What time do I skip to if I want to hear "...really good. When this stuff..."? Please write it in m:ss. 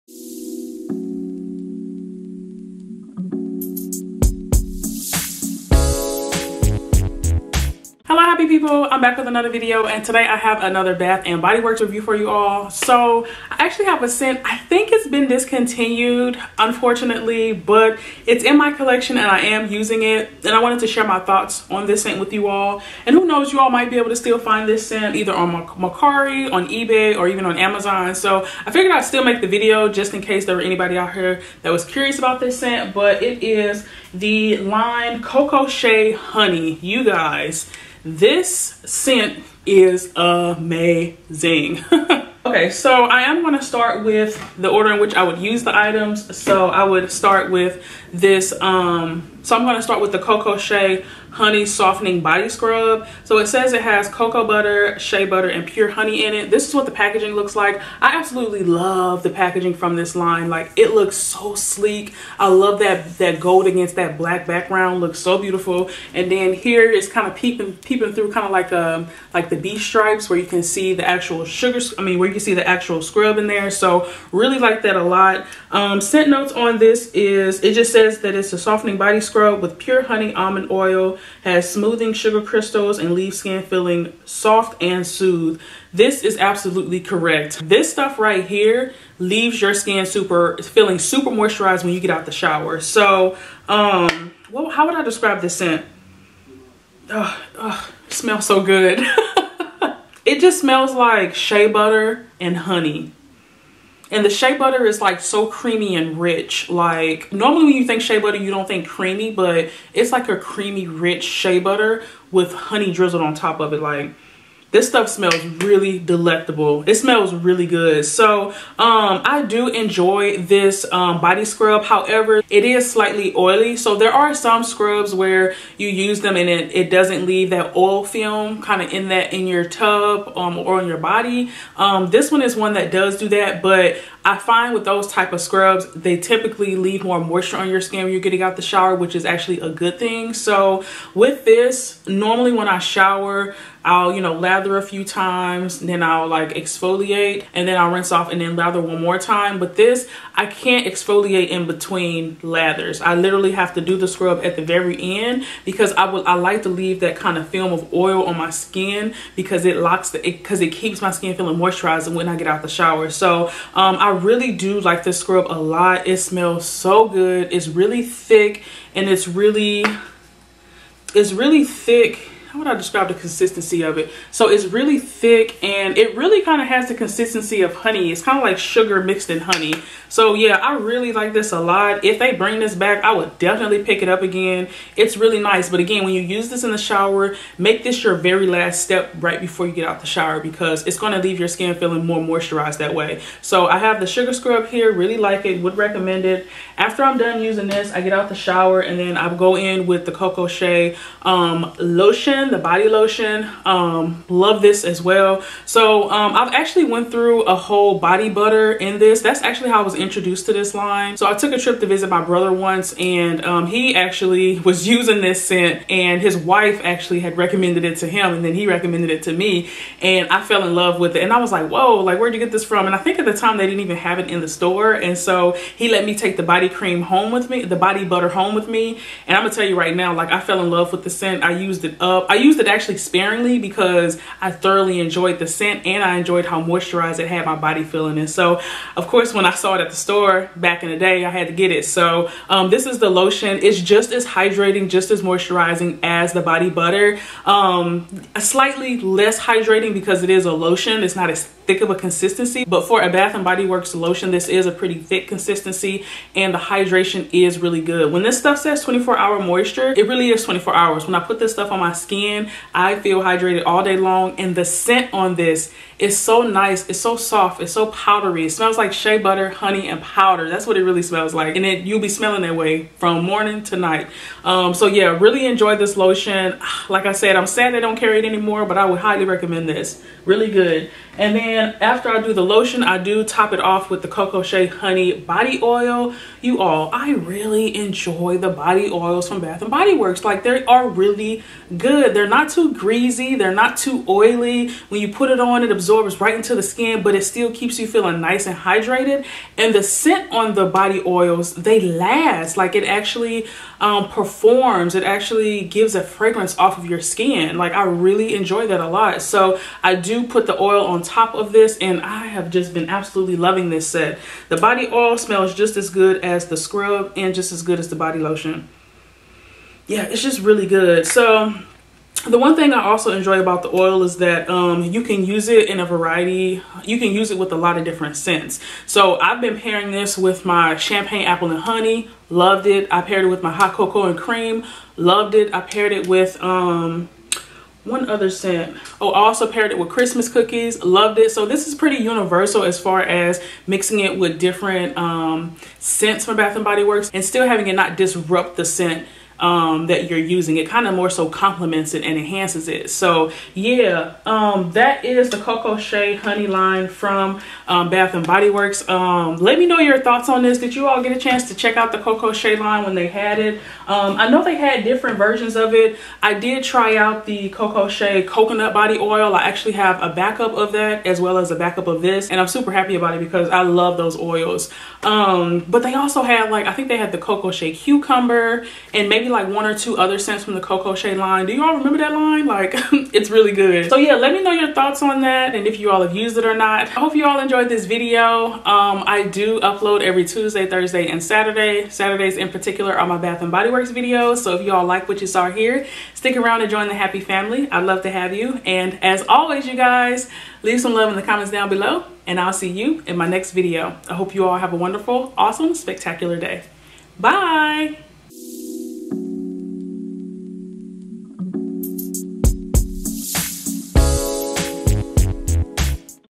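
4:17.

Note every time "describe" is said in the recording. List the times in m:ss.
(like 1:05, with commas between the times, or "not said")
1:35, 2:52.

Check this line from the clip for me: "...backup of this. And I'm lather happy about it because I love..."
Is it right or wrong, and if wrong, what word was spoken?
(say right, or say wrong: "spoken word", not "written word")
wrong: "super", not "lather".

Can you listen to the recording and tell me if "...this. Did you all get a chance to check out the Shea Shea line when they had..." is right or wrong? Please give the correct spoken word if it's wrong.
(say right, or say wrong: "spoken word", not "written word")
wrong: "Cocoa", not "Shea".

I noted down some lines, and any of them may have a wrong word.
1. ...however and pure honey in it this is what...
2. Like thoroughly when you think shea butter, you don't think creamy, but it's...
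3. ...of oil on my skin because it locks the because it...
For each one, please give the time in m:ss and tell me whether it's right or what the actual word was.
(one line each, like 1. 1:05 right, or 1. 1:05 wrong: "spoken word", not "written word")
1. 0:55 wrong: "butter", not "however"
2. 1:46 wrong: "normally", not "thoroughly"
3. 2:37 right.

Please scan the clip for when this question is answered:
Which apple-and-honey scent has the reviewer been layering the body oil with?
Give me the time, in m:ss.
5:30.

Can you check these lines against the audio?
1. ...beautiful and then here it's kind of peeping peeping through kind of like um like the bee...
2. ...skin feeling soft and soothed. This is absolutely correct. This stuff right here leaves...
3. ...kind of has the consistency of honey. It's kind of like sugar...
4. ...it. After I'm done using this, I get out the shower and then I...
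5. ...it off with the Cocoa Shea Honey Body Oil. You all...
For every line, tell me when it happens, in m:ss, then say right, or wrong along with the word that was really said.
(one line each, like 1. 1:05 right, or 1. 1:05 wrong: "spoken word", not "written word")
1. 1:05 right
2. 1:23 right
3. 2:56 right
4. 3:16 right
5. 4:43 right.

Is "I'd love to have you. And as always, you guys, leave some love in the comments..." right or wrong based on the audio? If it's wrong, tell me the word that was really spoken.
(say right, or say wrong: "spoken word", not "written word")
right.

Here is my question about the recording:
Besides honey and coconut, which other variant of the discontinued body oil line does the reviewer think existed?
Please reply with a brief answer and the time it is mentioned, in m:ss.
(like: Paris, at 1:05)
Cocoa Shea Cucumber, at 6:17.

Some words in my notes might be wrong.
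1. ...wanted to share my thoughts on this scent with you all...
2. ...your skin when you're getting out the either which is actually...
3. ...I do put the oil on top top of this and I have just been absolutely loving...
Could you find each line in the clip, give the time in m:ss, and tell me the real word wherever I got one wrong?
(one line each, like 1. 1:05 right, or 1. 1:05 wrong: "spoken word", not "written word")
1. 0:20 right
2. 2:17 wrong: "shower", not "either"
3. 5:09 right.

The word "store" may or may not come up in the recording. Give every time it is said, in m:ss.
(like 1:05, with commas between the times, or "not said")
3:44, 3:59.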